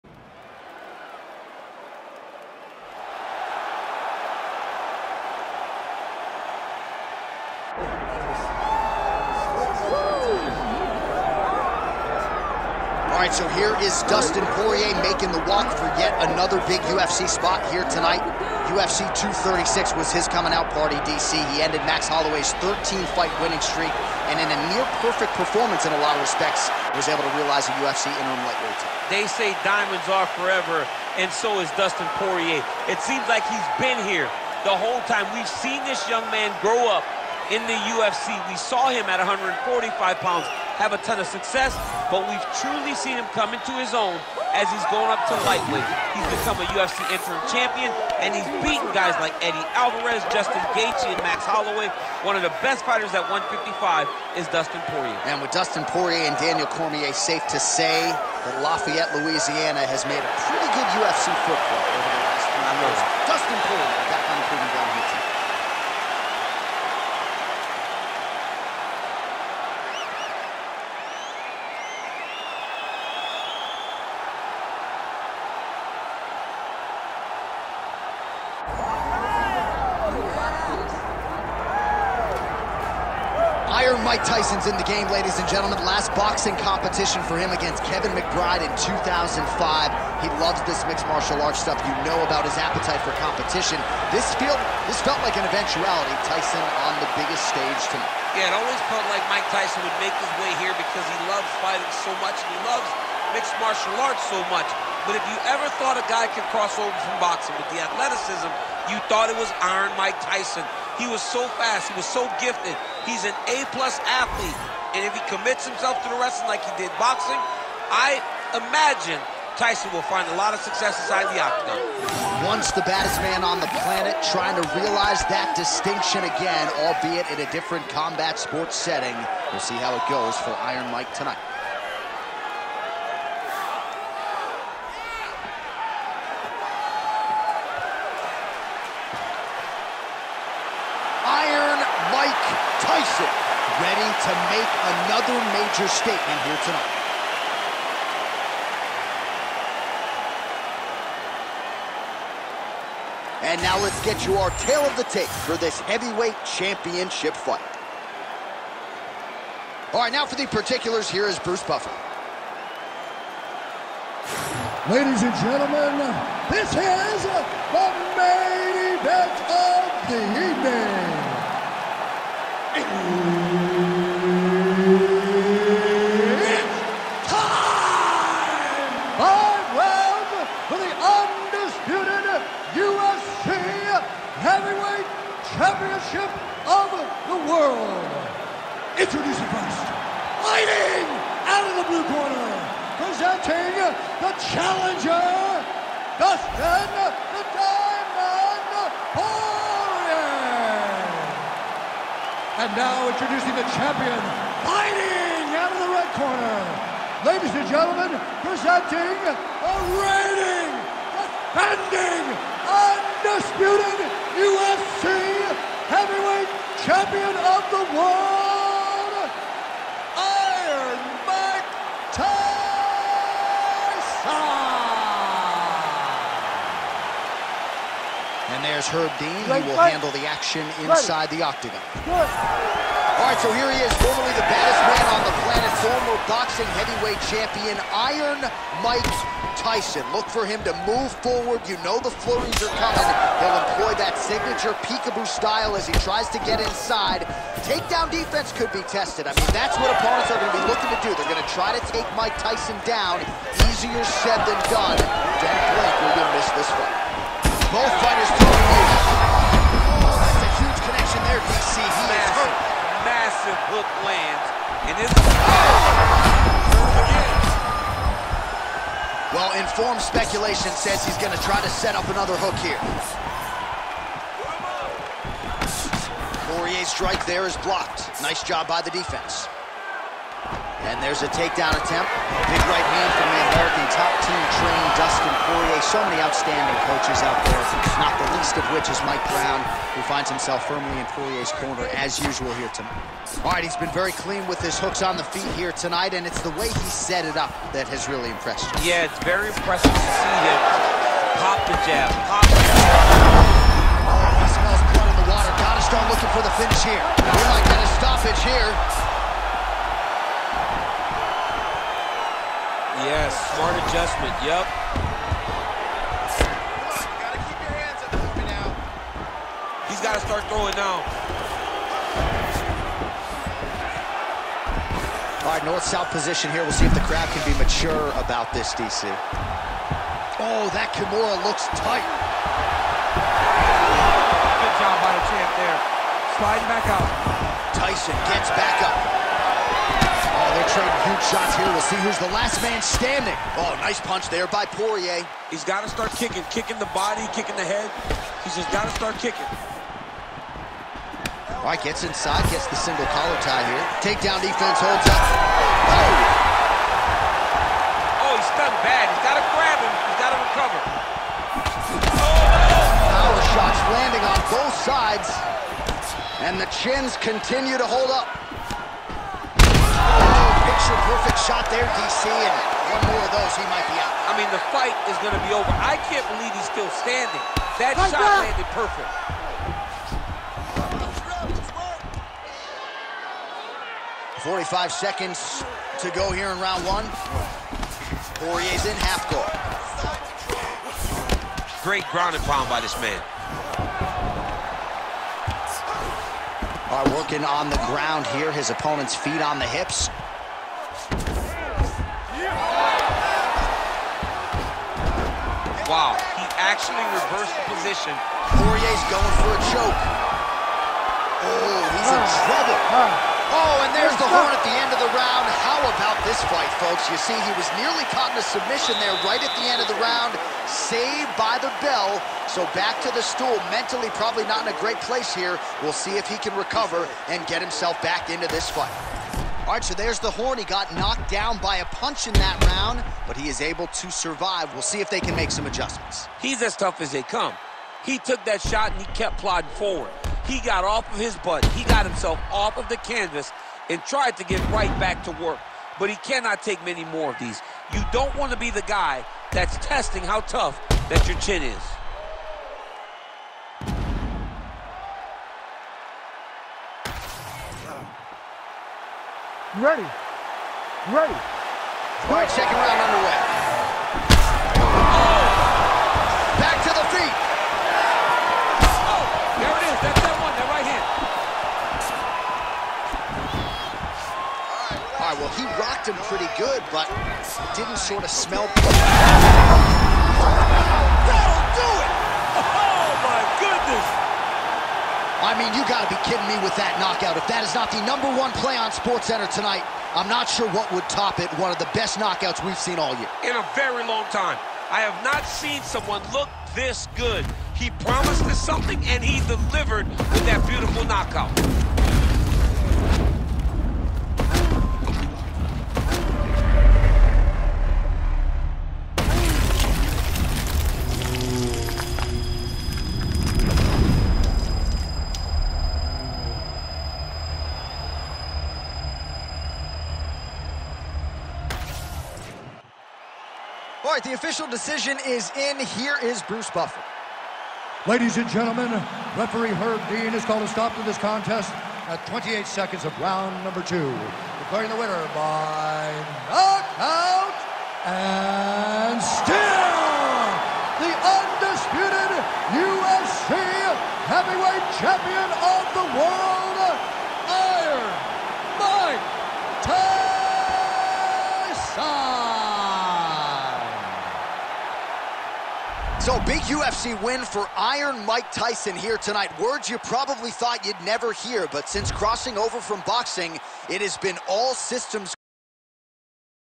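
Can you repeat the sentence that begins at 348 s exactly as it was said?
He's just got to start kicking.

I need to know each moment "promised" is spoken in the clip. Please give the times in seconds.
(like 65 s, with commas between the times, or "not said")
498 s.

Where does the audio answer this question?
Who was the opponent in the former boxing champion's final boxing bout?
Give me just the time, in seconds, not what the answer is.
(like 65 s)
87 s.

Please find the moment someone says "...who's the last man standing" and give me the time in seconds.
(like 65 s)
342 s.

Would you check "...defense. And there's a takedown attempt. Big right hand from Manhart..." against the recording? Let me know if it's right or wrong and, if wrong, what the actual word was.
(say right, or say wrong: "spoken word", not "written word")
right.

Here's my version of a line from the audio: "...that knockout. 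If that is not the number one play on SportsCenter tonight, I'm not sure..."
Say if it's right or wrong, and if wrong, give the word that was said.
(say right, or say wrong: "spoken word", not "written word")
right.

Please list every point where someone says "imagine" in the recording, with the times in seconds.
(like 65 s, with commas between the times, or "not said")
118 s.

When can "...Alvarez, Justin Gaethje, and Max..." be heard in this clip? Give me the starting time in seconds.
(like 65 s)
49 s.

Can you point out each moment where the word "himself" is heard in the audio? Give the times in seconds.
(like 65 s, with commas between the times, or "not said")
115 s, 290 s, 427 s, 442 s.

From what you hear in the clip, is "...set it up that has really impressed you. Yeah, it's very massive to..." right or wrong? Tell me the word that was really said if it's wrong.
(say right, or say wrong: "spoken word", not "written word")
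wrong: "impressive", not "massive".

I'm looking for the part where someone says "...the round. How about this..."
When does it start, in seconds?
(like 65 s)
415 s.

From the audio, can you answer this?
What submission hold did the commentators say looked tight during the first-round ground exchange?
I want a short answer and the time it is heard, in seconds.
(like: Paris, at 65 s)
Kimura, at 330 s.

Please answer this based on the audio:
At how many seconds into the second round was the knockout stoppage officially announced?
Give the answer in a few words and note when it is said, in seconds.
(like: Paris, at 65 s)
28, at 532 s.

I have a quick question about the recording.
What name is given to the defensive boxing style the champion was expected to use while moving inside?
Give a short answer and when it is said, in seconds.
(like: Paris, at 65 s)
peekaboo, at 244 s.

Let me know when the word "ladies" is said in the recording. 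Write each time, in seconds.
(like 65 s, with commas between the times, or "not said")
85 s, 164 s, 207 s, 528 s.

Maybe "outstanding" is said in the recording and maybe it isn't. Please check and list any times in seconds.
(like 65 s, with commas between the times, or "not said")
286 s.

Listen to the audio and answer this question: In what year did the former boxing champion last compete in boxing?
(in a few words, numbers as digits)
2005.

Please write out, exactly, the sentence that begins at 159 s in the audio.
All right, now for the particulars, here is Bruce Buffer.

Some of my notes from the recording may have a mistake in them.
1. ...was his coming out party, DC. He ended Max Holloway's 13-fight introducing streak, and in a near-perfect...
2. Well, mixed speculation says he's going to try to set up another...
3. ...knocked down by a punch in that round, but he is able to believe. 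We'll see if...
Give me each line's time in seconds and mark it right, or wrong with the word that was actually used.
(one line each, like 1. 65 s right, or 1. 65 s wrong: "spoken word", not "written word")
1. 19 s wrong: "winning", not "introducing"
2. 269 s wrong: "informed", not "mixed"
3. 430 s wrong: "survive", not "believe".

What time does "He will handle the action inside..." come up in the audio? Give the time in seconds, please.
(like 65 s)
229 s.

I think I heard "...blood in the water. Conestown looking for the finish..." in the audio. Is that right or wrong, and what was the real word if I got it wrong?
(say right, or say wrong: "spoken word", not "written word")
right.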